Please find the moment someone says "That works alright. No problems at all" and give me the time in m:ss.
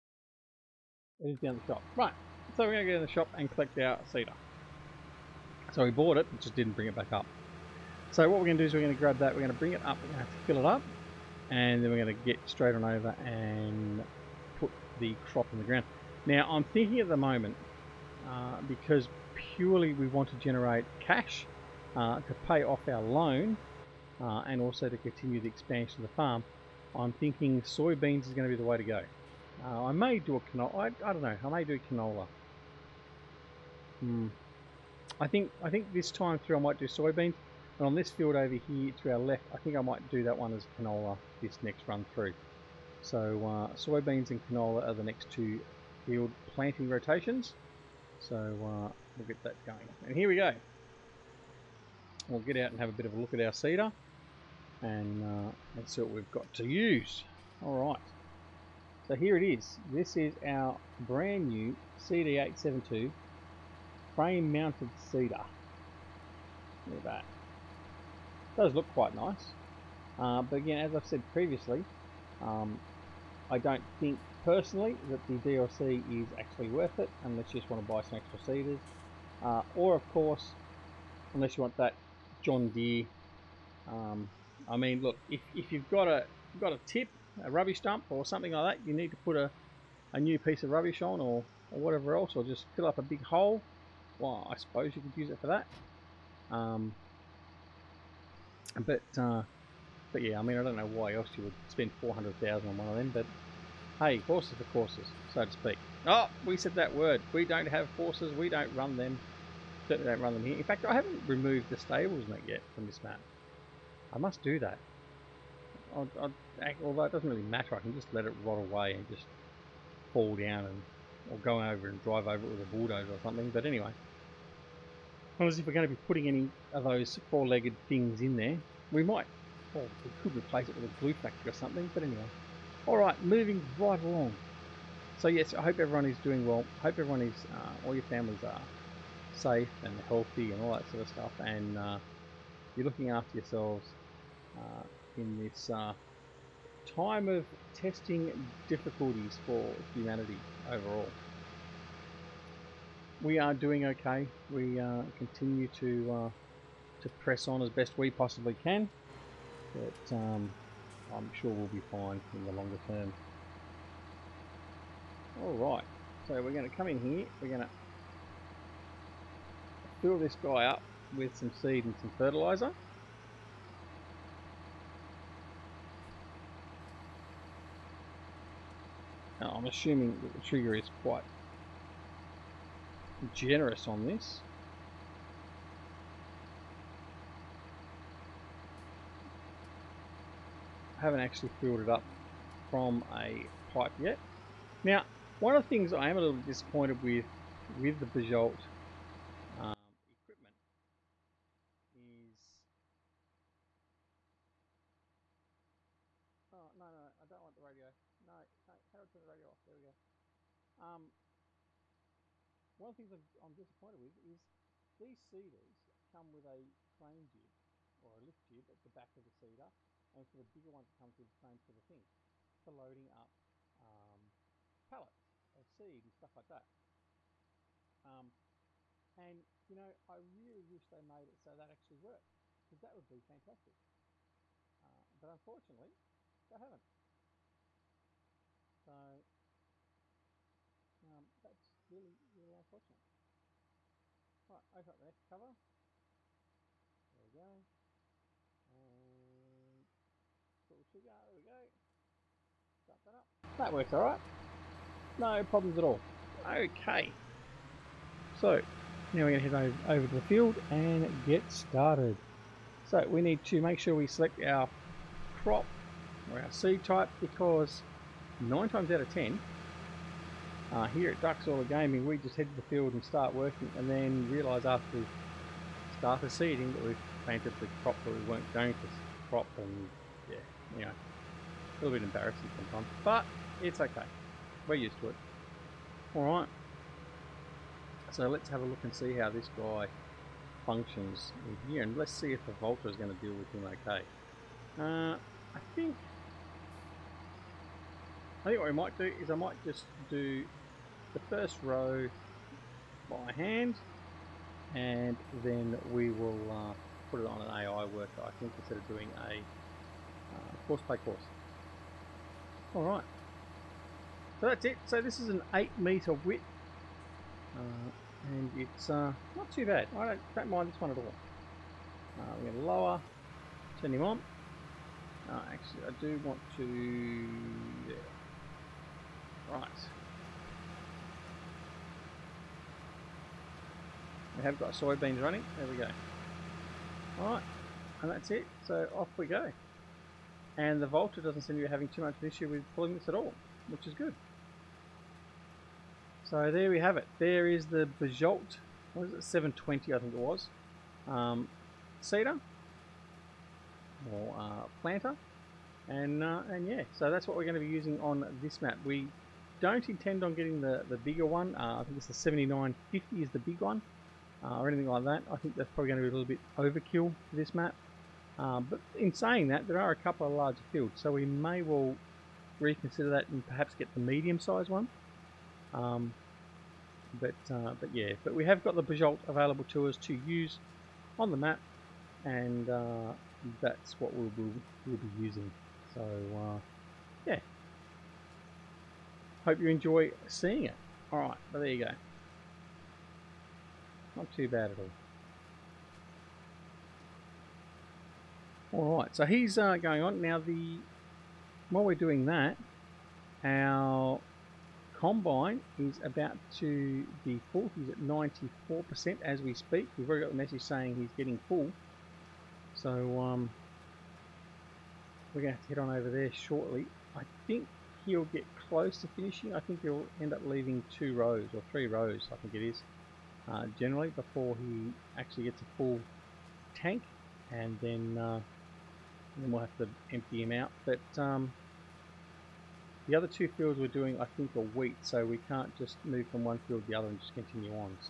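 4:13.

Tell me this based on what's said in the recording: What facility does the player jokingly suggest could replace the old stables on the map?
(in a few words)
A glue factory.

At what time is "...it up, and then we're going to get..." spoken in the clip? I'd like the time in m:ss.
0:10.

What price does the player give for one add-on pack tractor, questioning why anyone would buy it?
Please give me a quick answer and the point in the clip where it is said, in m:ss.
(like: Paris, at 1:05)
400,000, at 1:41.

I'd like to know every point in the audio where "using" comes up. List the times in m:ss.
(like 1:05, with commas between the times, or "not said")
5:57, 6:25.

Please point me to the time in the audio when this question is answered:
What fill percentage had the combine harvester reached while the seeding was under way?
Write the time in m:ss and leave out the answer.
6:47.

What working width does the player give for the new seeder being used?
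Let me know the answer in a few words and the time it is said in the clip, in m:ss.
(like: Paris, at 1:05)
8 metres, at 5:15.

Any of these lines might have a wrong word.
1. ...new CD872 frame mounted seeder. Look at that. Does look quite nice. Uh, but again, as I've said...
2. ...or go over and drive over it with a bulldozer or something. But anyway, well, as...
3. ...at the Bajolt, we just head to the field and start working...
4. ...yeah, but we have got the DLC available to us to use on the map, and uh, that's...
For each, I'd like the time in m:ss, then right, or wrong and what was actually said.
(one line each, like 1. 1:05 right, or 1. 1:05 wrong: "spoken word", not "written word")
1. 1:01 right
2. 2:01 right
3. 4:31 wrong: "Gaming", not "Bajolt"
4. 6:17 wrong: "Bajolt", not "DLC".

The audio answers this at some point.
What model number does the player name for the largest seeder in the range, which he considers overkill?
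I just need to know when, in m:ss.
6:02.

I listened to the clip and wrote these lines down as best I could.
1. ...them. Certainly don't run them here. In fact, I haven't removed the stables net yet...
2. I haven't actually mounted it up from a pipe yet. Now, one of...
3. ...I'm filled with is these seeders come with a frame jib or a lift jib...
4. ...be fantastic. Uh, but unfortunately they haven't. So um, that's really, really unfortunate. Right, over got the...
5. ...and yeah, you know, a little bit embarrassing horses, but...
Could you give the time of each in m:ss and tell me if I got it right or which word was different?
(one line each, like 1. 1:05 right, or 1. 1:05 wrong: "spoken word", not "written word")
1. 1:48 right
2. 3:10 wrong: "filled", not "mounted"
3. 3:33 wrong: "disappointed", not "filled"
4. 3:53 right
5. 4:39 wrong: "sometimes", not "horses".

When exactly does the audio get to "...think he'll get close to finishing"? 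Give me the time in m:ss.
6:57.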